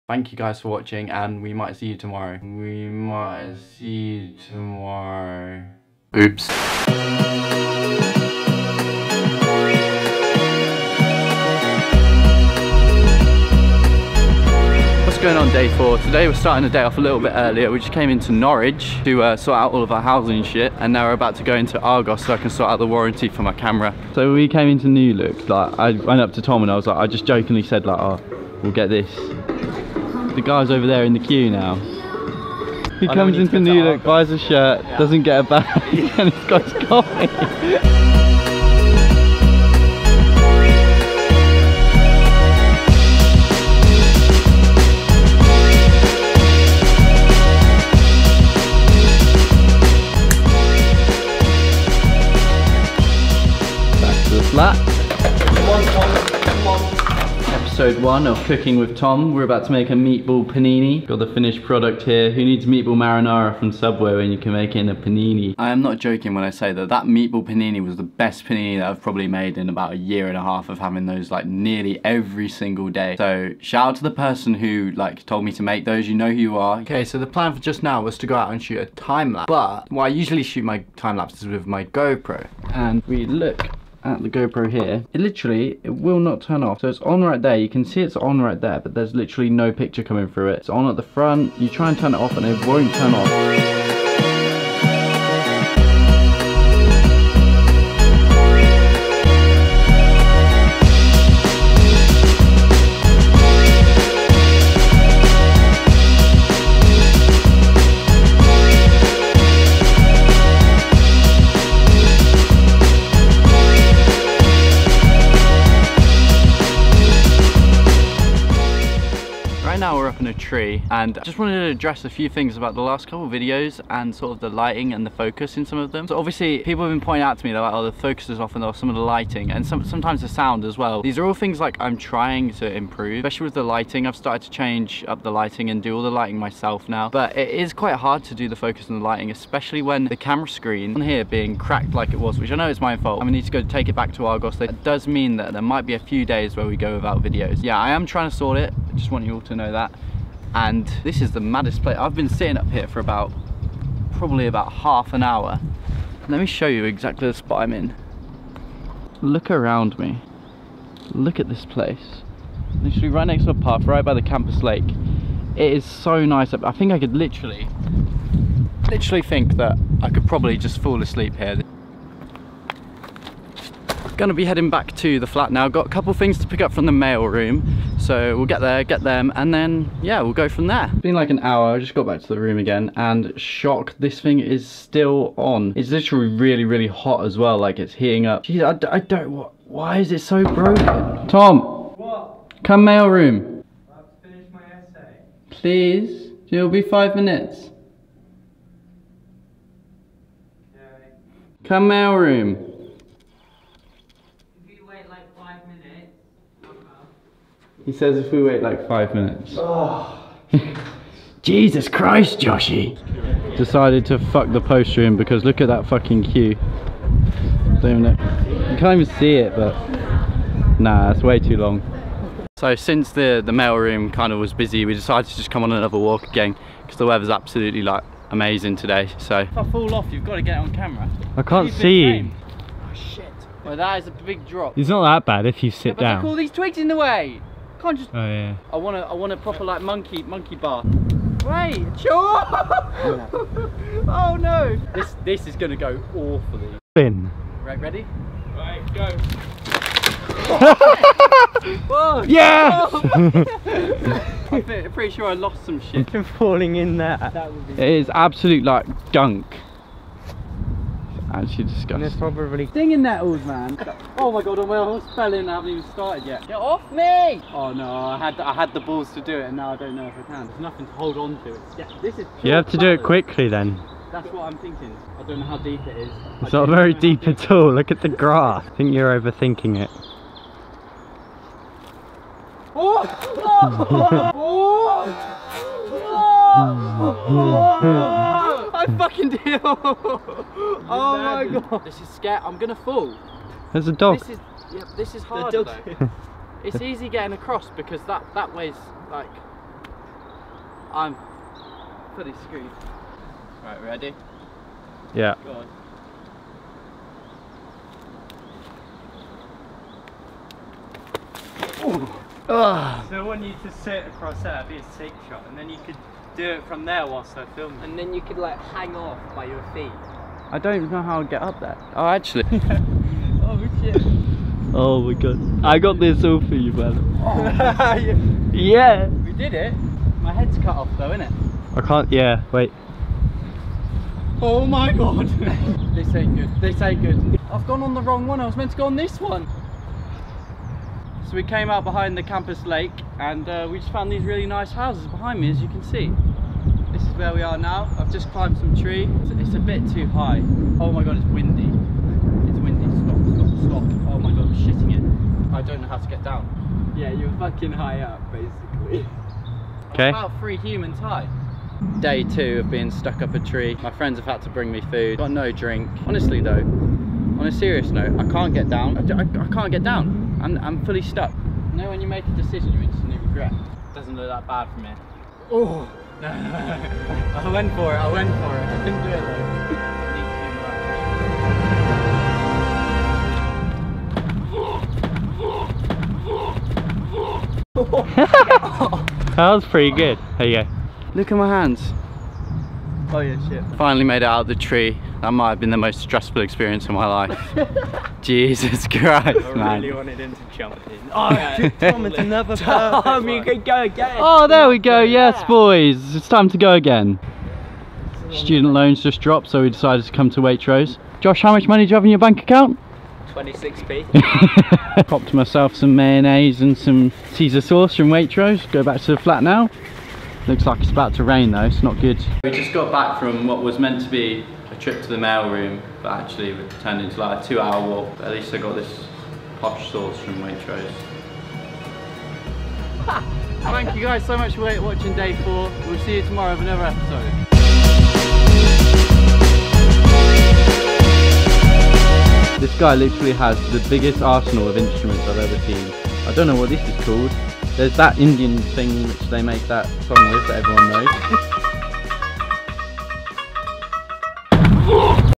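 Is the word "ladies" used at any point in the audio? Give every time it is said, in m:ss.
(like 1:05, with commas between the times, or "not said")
not said.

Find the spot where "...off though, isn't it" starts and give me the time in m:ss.
5:30.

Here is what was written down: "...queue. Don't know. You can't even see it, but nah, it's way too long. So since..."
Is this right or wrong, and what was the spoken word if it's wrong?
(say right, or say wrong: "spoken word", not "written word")
right.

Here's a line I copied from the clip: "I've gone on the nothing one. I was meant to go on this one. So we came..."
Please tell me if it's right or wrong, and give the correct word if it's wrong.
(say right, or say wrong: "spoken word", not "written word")
wrong: "wrong", not "nothing".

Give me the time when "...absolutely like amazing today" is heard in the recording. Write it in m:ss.
3:47.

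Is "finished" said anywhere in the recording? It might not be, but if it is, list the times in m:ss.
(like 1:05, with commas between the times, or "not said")
1:01, 3:14.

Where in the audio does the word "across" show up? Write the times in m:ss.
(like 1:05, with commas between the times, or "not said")
4:57, 5:14.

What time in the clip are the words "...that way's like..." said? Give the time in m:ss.
4:58.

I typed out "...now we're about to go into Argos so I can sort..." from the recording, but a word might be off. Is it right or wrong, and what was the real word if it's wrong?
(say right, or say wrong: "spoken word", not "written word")
right.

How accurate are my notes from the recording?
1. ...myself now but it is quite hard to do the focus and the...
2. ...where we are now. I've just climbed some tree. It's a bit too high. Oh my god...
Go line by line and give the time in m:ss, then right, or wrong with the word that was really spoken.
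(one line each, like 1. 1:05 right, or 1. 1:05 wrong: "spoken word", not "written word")
1. 2:16 right
2. 5:47 right.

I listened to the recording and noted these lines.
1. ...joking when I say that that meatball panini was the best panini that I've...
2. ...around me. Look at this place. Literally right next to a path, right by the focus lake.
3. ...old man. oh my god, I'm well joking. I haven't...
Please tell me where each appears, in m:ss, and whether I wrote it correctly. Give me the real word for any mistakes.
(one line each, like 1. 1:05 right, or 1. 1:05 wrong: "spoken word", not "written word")
1. 1:05 right
2. 2:39 wrong: "campus", not "focus"
3. 4:23 wrong: "spelling", not "joking".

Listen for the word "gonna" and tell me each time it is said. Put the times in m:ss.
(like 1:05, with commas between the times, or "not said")
2:23, 2:54, 4:05, 4:52.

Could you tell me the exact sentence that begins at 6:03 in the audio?
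My friends have had to bring me food.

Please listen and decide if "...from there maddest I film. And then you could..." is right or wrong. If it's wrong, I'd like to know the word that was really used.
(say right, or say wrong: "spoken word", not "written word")
wrong: "whilst", not "maddest".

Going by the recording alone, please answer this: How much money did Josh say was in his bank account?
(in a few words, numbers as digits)
26p.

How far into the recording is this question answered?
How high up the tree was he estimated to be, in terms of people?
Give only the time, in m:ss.
6:00.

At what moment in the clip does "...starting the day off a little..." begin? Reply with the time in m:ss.
0:16.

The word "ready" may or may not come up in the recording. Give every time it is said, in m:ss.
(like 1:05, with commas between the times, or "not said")
4:07, 5:03.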